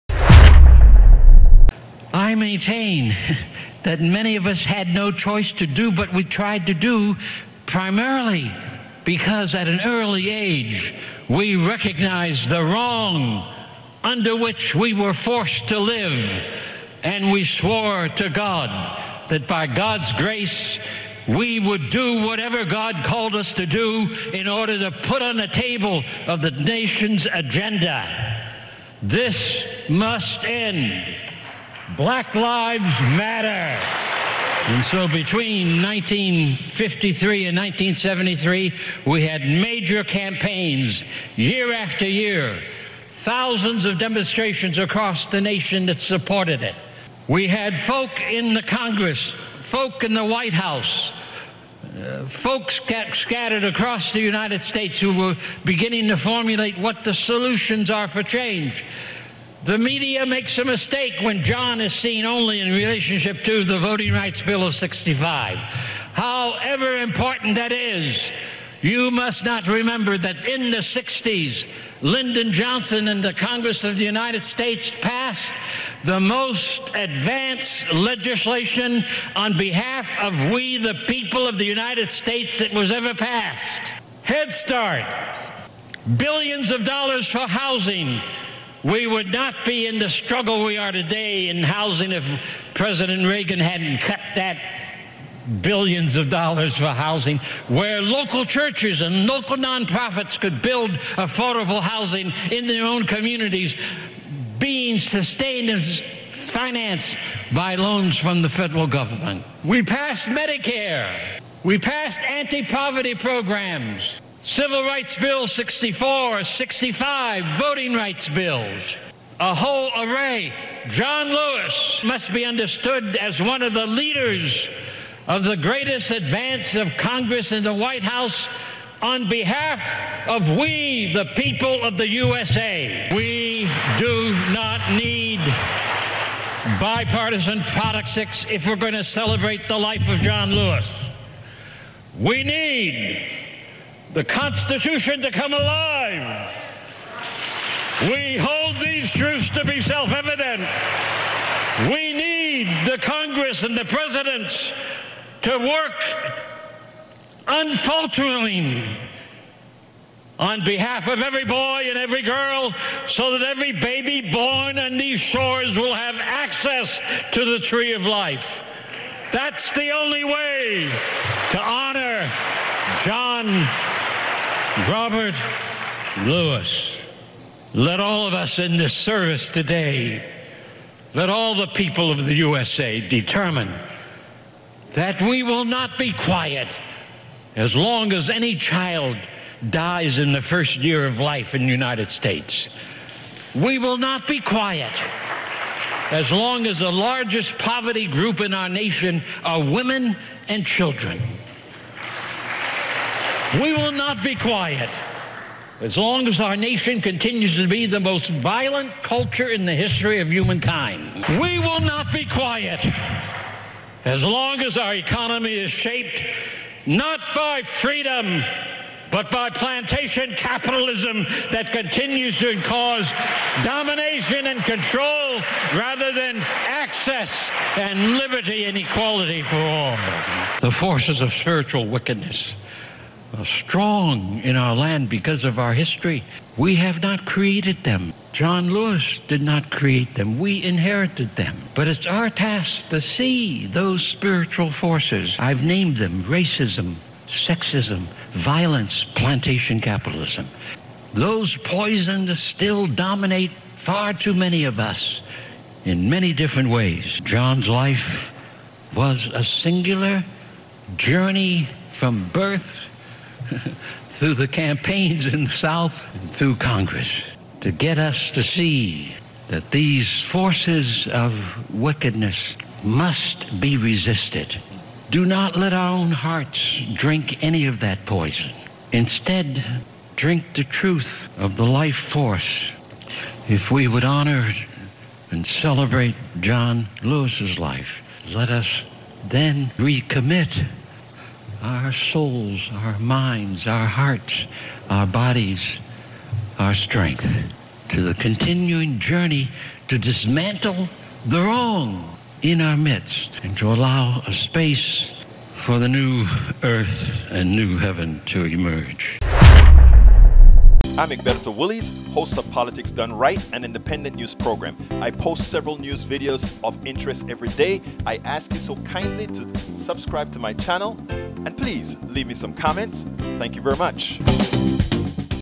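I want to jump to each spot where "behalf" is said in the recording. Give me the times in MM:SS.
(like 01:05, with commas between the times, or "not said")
01:19, 02:09, 02:40.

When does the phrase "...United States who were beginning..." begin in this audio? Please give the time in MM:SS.
00:54.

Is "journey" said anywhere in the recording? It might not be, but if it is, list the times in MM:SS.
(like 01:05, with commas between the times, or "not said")
04:20, 04:58.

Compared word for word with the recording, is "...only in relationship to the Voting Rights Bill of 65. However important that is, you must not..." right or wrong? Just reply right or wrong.
right.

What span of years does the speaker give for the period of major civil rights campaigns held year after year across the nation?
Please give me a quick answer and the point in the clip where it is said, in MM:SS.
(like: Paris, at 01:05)
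1953 and 1973, at 00:35.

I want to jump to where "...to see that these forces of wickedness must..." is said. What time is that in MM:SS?
04:28.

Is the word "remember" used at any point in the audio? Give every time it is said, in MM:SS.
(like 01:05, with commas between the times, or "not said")
01:09.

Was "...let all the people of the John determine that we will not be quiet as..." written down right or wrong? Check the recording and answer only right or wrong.
wrong.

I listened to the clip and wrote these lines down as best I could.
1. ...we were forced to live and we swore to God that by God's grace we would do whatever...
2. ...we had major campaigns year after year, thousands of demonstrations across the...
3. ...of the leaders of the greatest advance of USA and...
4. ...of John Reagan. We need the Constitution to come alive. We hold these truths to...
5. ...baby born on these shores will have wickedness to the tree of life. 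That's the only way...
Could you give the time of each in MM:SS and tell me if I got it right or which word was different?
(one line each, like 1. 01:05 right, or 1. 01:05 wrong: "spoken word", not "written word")
1. 00:14 right
2. 00:39 right
3. 02:03 wrong: "Congress", not "USA"
4. 02:20 wrong: "Lewis", not "Reagan"
5. 02:43 wrong: "access", not "wickedness".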